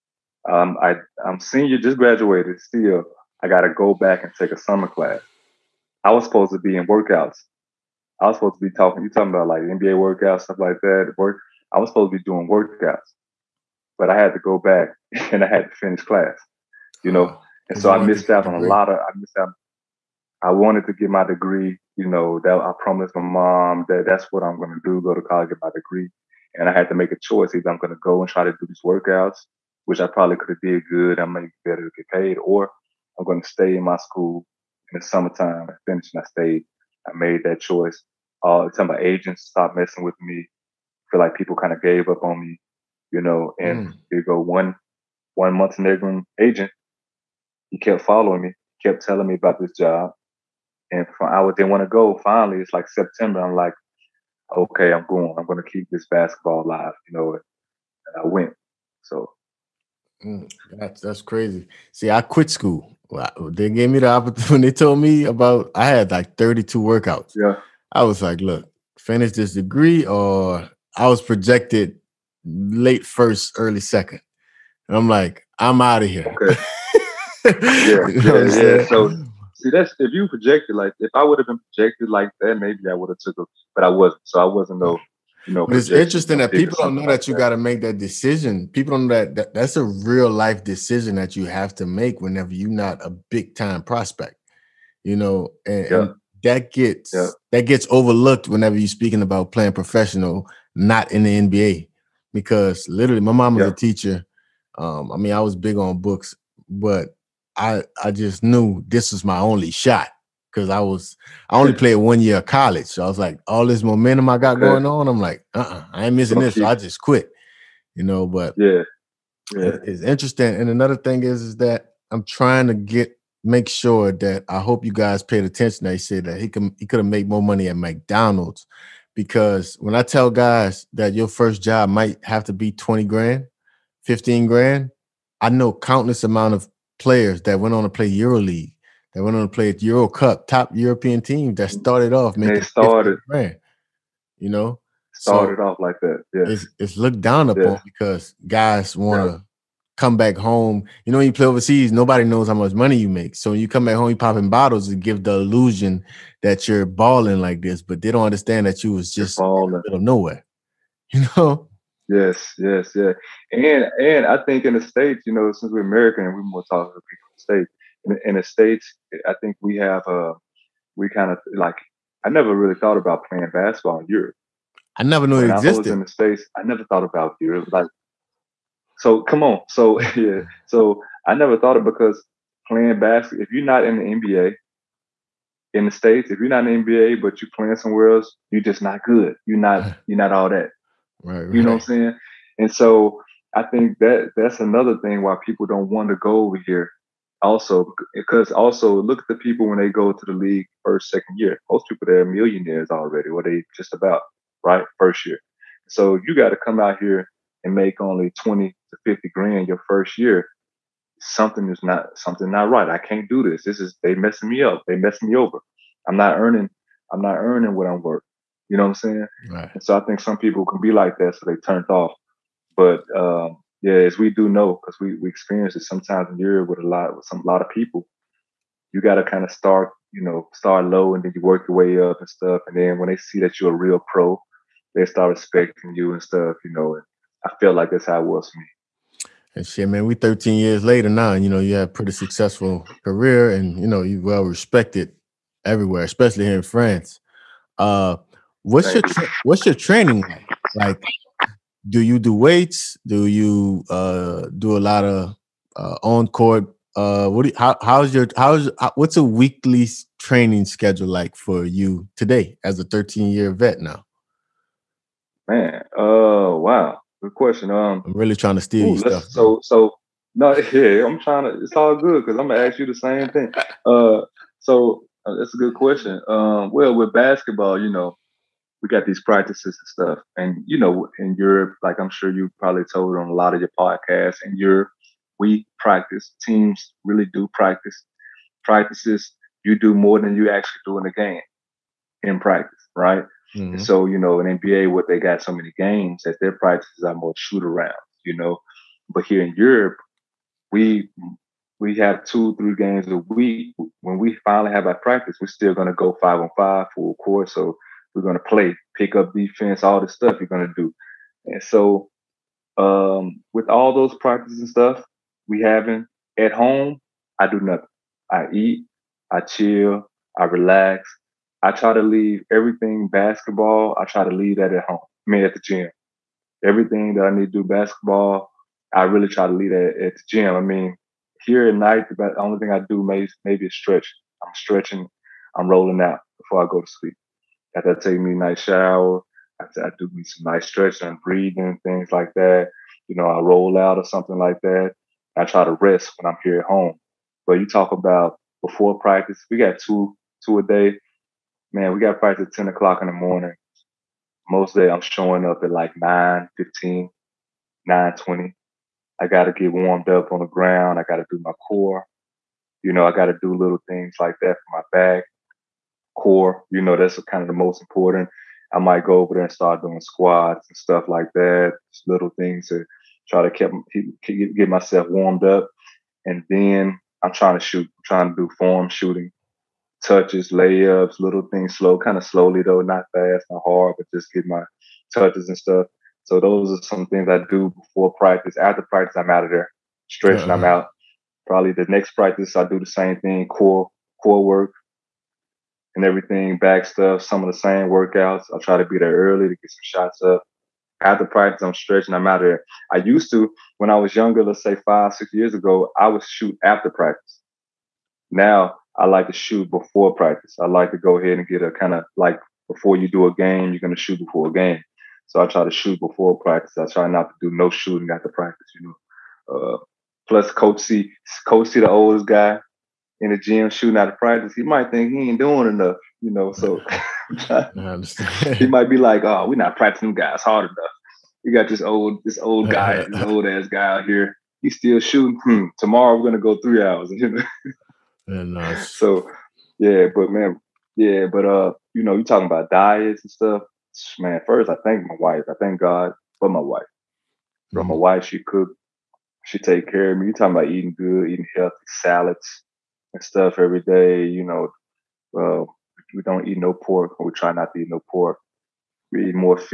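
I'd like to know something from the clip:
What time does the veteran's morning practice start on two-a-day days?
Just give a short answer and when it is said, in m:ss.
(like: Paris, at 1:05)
10 o'clock, at 5:52.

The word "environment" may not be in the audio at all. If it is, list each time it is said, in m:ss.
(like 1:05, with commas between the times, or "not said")
not said.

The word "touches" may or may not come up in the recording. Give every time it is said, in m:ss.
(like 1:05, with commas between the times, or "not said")
6:20, 6:25.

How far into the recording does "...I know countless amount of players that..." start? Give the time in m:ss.
2:15.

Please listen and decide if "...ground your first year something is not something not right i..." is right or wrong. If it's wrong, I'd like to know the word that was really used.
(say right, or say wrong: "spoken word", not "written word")
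wrong: "grand", not "ground".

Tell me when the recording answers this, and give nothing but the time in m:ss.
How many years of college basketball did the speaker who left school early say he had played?
1:51.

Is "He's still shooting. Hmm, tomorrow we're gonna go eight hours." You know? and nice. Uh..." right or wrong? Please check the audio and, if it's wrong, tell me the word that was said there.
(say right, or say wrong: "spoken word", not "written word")
wrong: "three", not "eight".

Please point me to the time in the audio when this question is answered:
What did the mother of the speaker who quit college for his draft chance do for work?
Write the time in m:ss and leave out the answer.
1:43.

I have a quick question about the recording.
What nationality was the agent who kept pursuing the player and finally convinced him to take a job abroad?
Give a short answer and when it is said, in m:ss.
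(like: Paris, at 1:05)
Montenegrin, at 0:45.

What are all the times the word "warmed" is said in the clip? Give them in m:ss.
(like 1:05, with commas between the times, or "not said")
5:59, 6:15.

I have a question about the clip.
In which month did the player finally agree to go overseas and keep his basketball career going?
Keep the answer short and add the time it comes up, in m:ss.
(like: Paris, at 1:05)
September, at 0:52.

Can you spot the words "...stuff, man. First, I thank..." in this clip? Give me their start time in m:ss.
7:23.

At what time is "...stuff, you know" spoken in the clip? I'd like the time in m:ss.
3:56.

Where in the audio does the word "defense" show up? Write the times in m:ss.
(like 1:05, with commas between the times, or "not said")
5:09.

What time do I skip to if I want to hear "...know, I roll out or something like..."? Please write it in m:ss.
5:43.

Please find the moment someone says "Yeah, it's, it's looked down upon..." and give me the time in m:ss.
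2:26.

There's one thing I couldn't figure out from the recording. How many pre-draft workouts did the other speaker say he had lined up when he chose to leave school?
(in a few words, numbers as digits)
32.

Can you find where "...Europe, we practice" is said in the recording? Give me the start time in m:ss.
4:44.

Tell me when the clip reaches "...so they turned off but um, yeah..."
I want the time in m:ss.
3:41.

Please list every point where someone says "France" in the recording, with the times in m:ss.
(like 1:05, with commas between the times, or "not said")
4:06.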